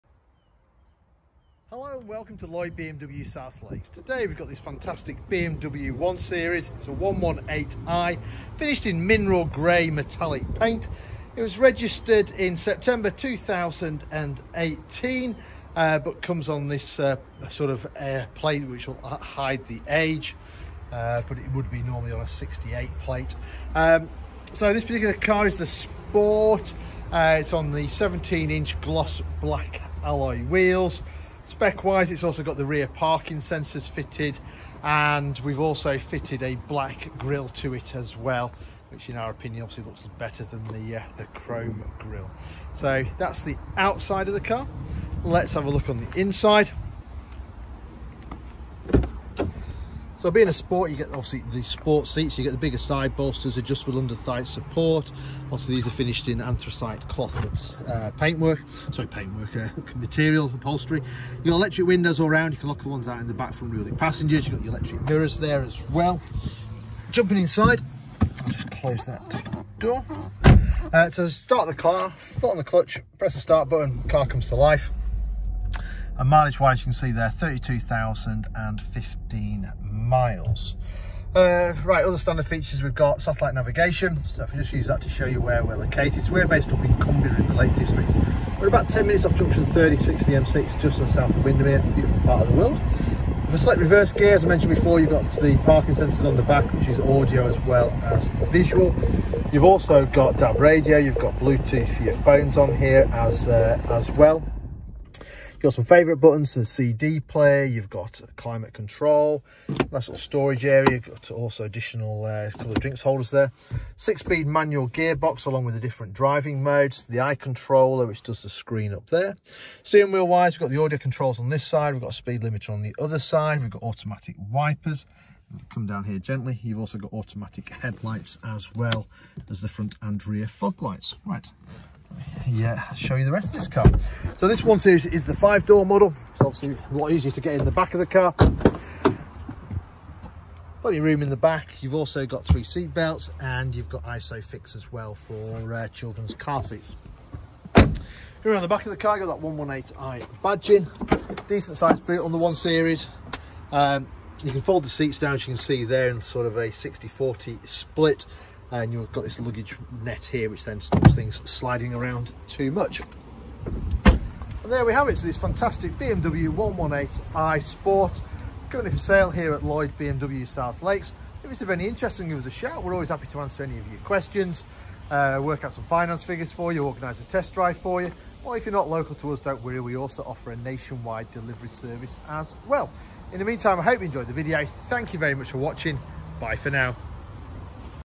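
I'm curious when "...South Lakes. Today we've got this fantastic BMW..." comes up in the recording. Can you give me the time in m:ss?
0:03.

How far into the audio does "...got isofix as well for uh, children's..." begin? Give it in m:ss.
2:23.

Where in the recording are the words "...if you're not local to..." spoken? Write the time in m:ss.
2:58.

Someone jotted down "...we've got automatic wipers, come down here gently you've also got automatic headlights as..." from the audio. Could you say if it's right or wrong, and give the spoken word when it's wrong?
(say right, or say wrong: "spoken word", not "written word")
right.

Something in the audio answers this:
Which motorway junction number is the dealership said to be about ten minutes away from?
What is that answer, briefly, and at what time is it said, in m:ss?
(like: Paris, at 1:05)
36, at 1:29.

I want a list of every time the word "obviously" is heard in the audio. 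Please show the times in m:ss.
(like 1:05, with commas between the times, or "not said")
0:39, 0:51, 0:55, 2:16.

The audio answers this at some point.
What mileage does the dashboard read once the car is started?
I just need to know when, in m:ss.
1:17.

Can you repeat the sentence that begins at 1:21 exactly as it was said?
Uh, right, other standard features we've got satellite navigation.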